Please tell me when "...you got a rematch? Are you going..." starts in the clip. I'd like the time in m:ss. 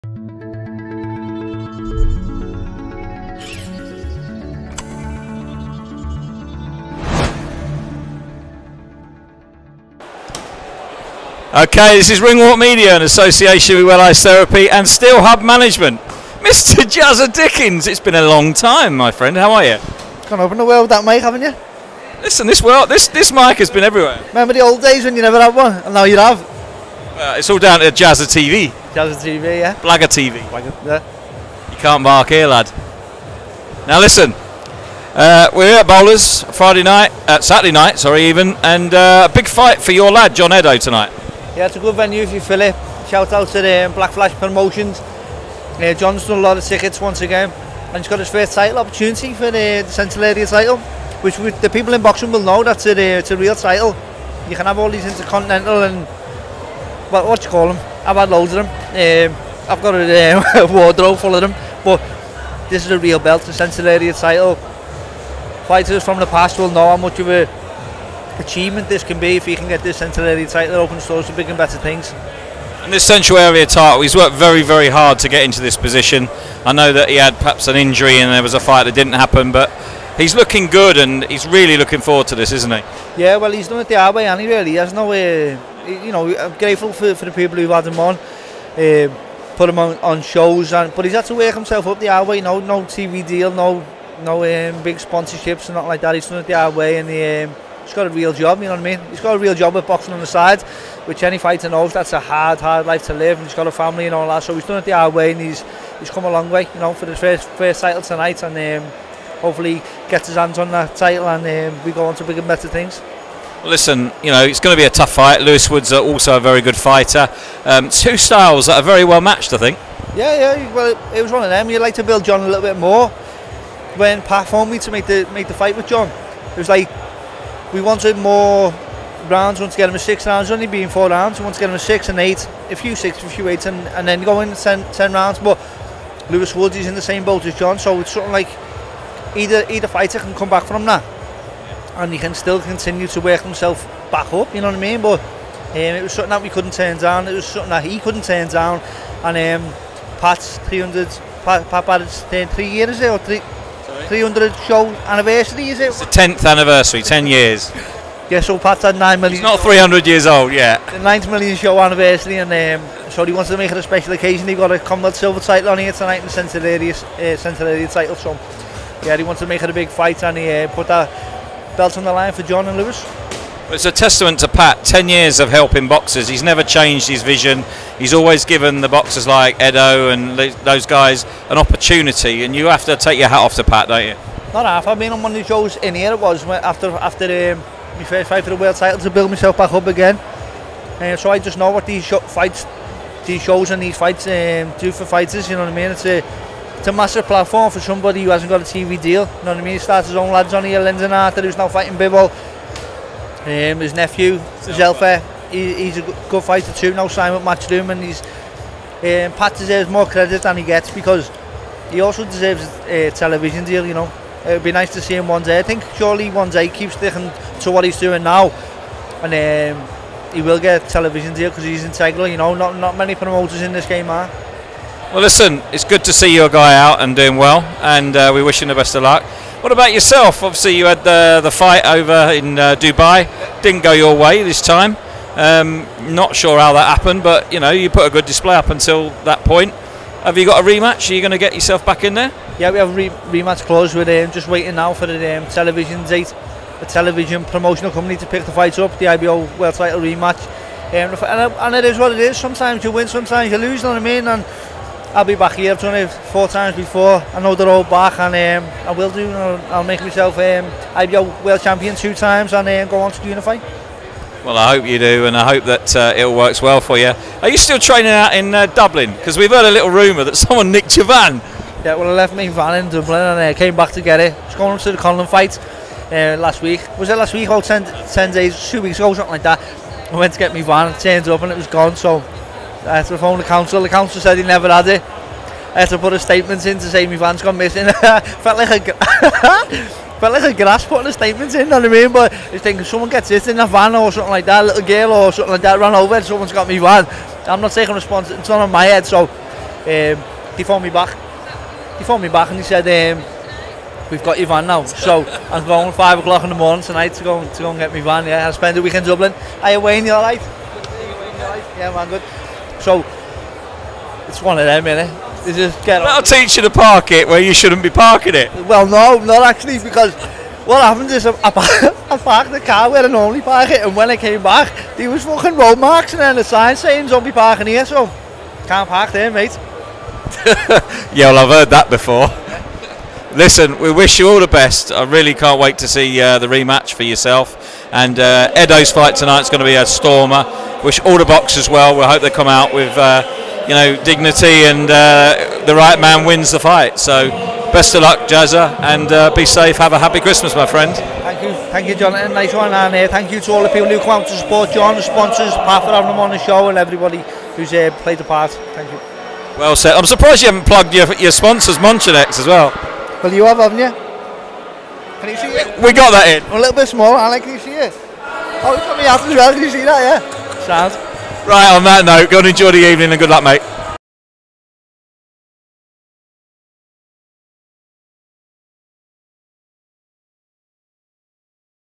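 4:00.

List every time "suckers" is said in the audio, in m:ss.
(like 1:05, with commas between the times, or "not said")
not said.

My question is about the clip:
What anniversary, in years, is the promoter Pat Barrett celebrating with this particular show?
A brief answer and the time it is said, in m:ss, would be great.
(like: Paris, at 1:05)
10, at 2:37.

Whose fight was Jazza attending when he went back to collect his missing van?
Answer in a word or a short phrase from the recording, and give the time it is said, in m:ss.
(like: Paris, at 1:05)
Conlan, at 4:34.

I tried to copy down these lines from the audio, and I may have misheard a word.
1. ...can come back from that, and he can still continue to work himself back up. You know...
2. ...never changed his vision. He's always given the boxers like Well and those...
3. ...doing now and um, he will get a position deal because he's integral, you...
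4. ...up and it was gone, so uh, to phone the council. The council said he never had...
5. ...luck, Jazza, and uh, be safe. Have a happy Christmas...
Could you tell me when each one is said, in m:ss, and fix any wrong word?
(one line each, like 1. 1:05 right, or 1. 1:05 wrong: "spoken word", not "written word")
1. 2:20 right
2. 2:56 wrong: "Edo", not "Well"
3. 3:37 wrong: "television", not "position"
4. 4:41 right
5. 5:48 right.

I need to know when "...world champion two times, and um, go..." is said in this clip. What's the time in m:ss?
4:21.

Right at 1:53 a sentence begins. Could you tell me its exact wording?
Listen, you know, it's going to be a tough fight.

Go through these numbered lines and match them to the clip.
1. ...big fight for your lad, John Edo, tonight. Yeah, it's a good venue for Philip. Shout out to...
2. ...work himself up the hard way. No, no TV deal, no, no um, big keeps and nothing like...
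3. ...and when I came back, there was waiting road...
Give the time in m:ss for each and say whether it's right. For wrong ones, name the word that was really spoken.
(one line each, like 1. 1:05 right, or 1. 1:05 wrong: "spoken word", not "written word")
1. 0:39 right
2. 1:31 wrong: "sponsorships", not "keeps"
3. 5:23 wrong: "fucking", not "waiting".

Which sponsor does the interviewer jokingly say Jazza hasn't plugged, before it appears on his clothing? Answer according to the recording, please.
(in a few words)
Monchinex.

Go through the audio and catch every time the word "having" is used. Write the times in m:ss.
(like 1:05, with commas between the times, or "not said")
5:55.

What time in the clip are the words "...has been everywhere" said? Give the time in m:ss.
0:23.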